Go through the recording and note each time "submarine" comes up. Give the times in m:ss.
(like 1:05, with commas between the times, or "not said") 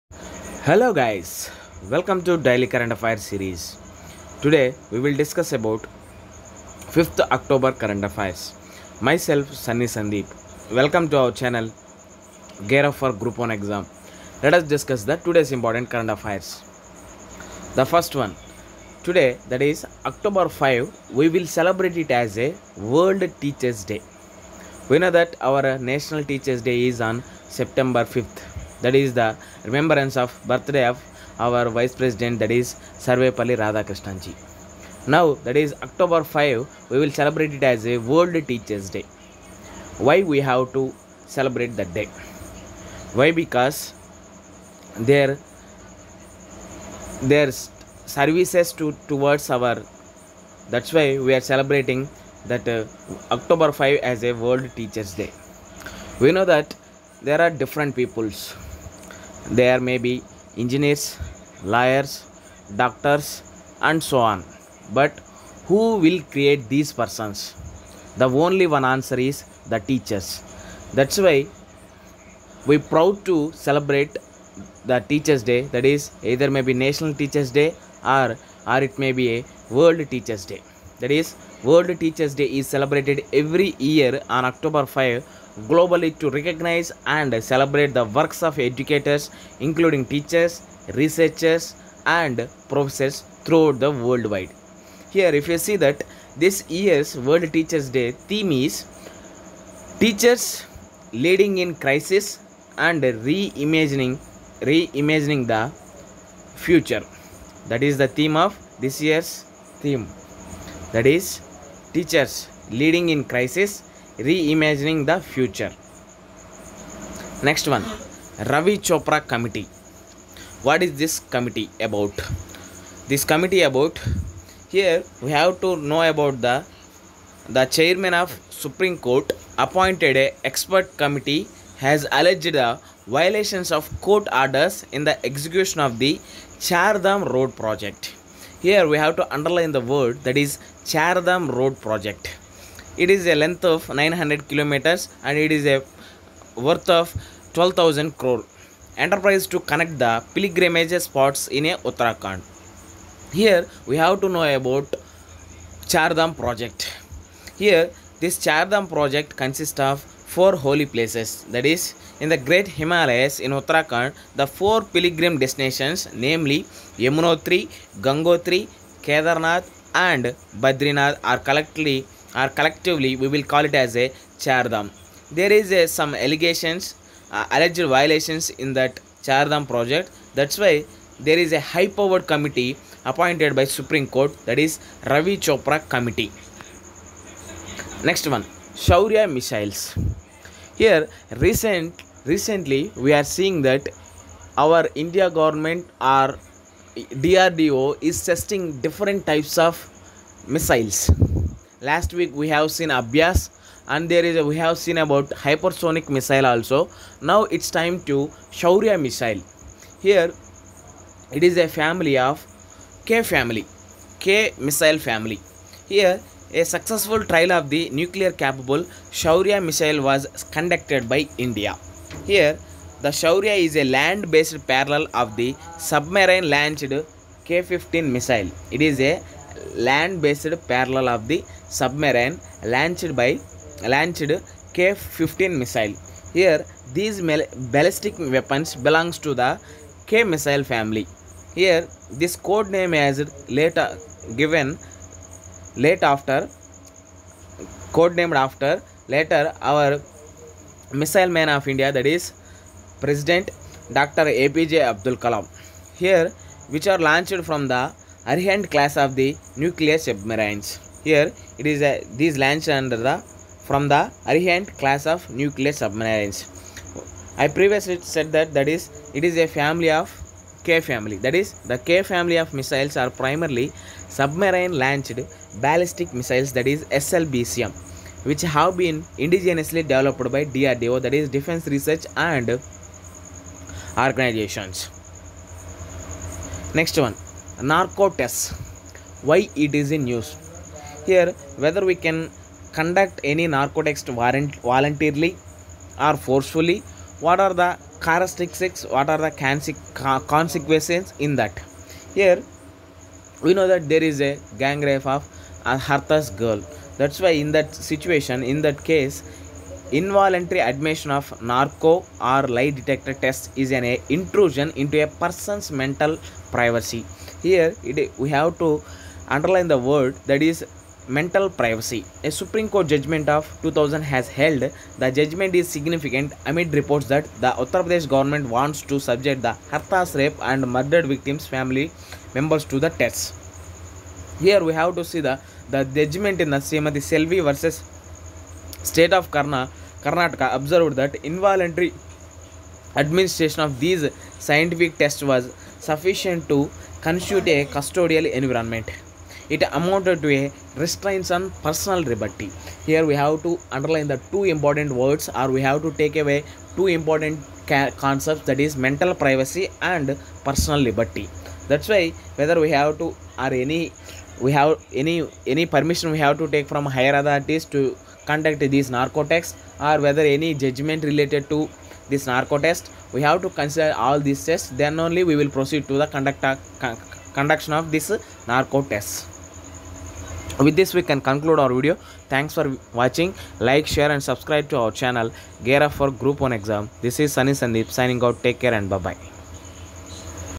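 3:45, 3:51, 4:19, 4:25, 4:34.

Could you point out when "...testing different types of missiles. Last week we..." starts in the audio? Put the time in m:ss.
3:18.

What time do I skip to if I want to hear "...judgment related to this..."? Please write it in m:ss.
6:10.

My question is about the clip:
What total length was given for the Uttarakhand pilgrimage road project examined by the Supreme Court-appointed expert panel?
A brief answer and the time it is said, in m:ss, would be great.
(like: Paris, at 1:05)
900 kilometers, at 2:23.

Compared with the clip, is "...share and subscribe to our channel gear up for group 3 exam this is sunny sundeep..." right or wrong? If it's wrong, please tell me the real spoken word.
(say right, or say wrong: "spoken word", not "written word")
wrong: "1", not "3".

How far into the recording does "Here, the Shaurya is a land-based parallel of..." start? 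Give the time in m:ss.
3:42.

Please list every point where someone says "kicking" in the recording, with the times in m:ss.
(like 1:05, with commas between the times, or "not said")
not said.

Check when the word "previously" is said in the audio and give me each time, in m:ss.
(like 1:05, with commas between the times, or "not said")
4:27.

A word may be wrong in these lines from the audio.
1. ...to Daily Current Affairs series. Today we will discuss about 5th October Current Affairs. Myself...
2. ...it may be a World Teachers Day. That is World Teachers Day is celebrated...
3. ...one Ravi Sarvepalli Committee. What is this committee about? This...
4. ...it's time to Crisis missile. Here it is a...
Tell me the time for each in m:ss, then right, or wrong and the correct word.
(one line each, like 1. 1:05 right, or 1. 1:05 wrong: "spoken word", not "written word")
1. 0:02 right
2. 1:18 right
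3. 1:57 wrong: "Chopra", not "Sarvepalli"
4. 3:27 wrong: "Shaurya", not "Crisis".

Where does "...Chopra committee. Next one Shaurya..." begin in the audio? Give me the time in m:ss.
3:05.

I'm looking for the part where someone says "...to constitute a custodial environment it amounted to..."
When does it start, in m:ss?
5:46.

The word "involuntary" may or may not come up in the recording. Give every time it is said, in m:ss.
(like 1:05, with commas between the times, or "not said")
5:09, 5:41.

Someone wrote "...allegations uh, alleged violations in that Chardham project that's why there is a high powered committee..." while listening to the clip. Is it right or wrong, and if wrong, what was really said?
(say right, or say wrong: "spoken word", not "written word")
right.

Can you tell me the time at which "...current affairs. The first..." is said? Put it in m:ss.
0:15.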